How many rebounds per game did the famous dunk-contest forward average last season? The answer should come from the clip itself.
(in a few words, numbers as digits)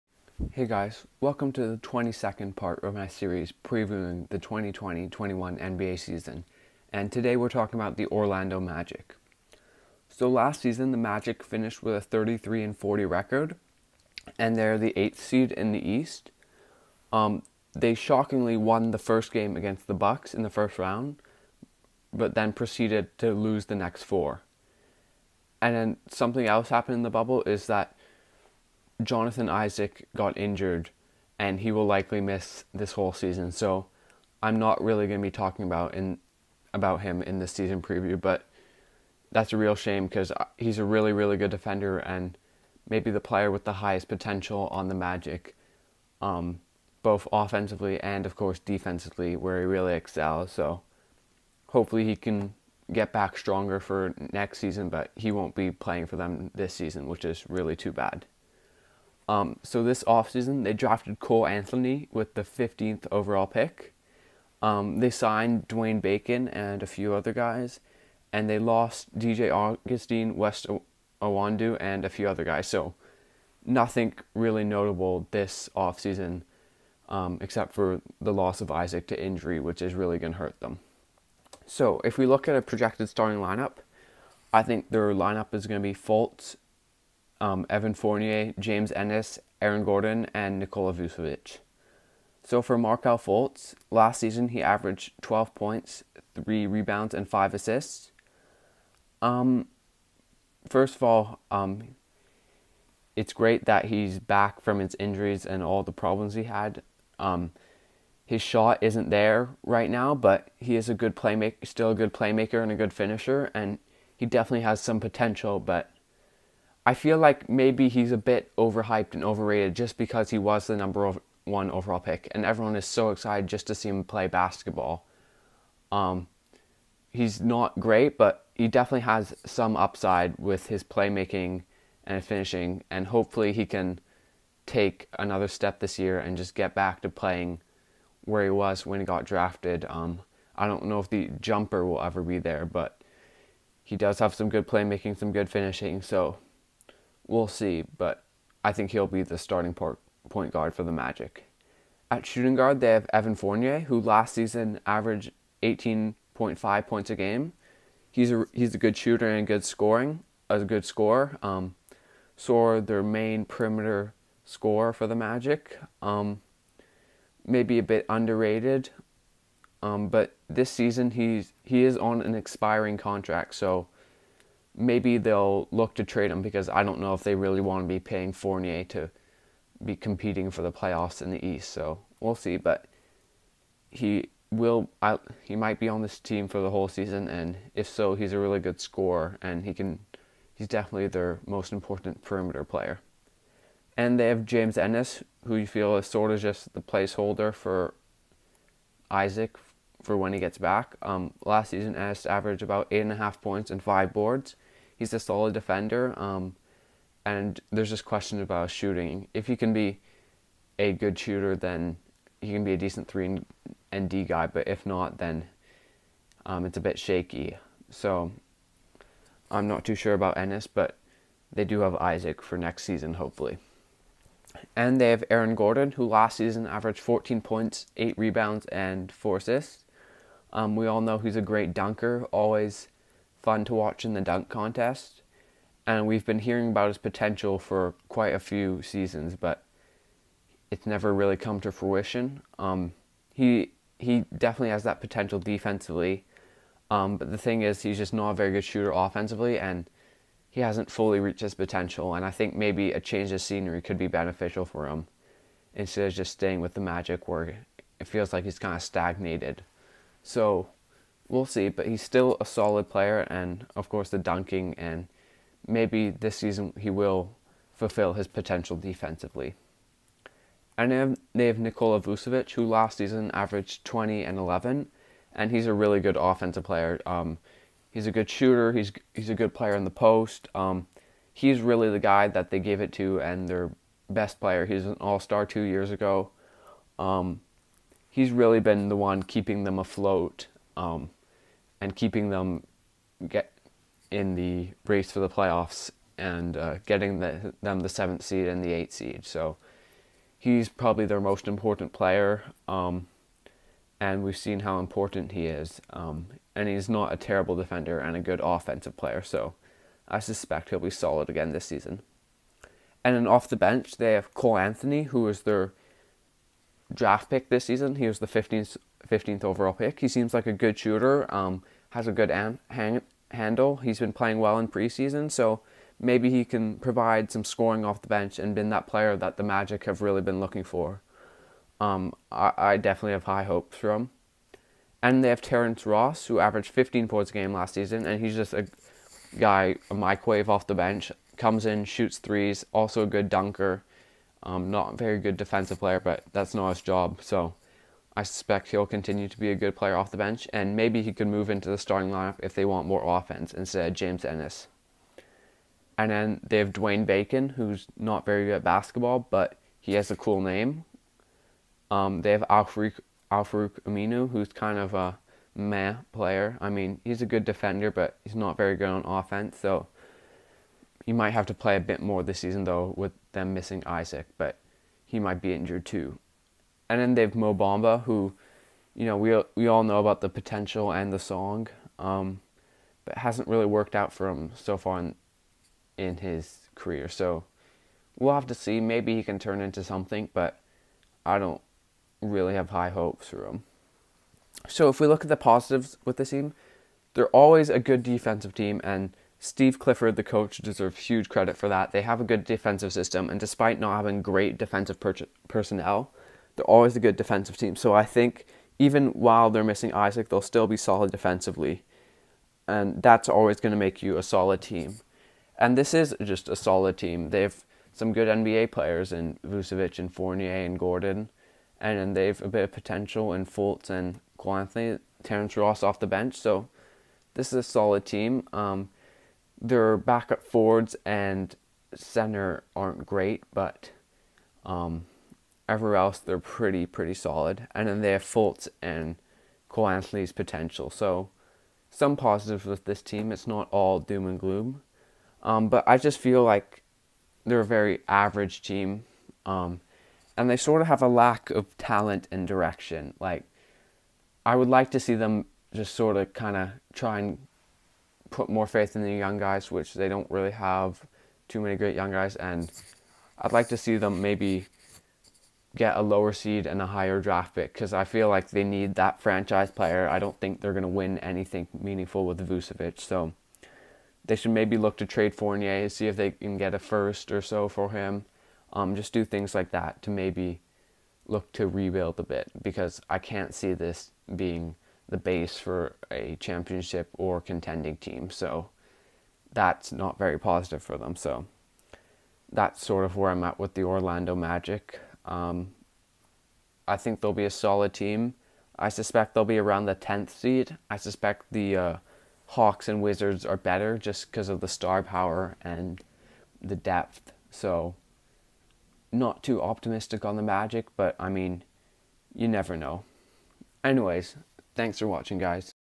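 8.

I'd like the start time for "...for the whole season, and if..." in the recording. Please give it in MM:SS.
03:06.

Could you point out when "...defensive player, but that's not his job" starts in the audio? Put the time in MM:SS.
05:45.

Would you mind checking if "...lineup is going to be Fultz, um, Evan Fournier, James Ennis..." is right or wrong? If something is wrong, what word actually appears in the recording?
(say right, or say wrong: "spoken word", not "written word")
right.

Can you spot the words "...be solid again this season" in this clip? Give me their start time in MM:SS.
05:10.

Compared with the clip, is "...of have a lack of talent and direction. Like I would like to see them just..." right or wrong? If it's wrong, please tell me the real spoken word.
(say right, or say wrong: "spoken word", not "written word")
right.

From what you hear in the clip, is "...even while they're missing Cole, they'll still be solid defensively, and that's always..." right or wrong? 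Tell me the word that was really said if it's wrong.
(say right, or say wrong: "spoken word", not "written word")
wrong: "Isaac", not "Cole".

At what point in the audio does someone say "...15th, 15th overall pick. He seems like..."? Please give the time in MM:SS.
05:18.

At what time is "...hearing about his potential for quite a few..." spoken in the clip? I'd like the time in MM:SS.
03:56.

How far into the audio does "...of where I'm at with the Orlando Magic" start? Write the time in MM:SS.
08:13.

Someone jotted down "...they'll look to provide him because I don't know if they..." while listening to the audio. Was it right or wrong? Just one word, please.
wrong.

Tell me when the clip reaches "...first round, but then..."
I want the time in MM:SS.
00:20.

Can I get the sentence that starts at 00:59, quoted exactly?
Um, so this offseason, they drafted Cole Anthony with the 15th overall pick.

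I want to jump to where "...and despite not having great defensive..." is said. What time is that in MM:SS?
06:43.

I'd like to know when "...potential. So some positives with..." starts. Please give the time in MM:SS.
07:20.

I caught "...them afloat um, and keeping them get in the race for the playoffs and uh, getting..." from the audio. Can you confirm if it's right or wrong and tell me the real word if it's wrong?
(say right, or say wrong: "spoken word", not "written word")
right.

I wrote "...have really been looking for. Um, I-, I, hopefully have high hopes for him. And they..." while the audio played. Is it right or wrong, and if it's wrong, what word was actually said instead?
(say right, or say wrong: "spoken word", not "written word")
wrong: "definitely", not "hopefully".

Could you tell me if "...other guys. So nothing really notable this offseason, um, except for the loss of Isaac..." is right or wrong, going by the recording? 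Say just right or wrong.
right.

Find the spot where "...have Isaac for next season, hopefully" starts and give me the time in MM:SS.
03:41.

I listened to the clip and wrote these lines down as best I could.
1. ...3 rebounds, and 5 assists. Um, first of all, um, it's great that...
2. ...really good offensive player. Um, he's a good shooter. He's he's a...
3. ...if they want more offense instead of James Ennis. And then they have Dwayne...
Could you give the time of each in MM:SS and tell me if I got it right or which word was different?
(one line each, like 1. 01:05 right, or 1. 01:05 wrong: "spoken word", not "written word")
1. 01:36 right
2. 04:35 right
3. 05:52 right.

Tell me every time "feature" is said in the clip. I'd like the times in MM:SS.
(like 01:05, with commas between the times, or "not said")
not said.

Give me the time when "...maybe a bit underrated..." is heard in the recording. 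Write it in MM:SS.
02:47.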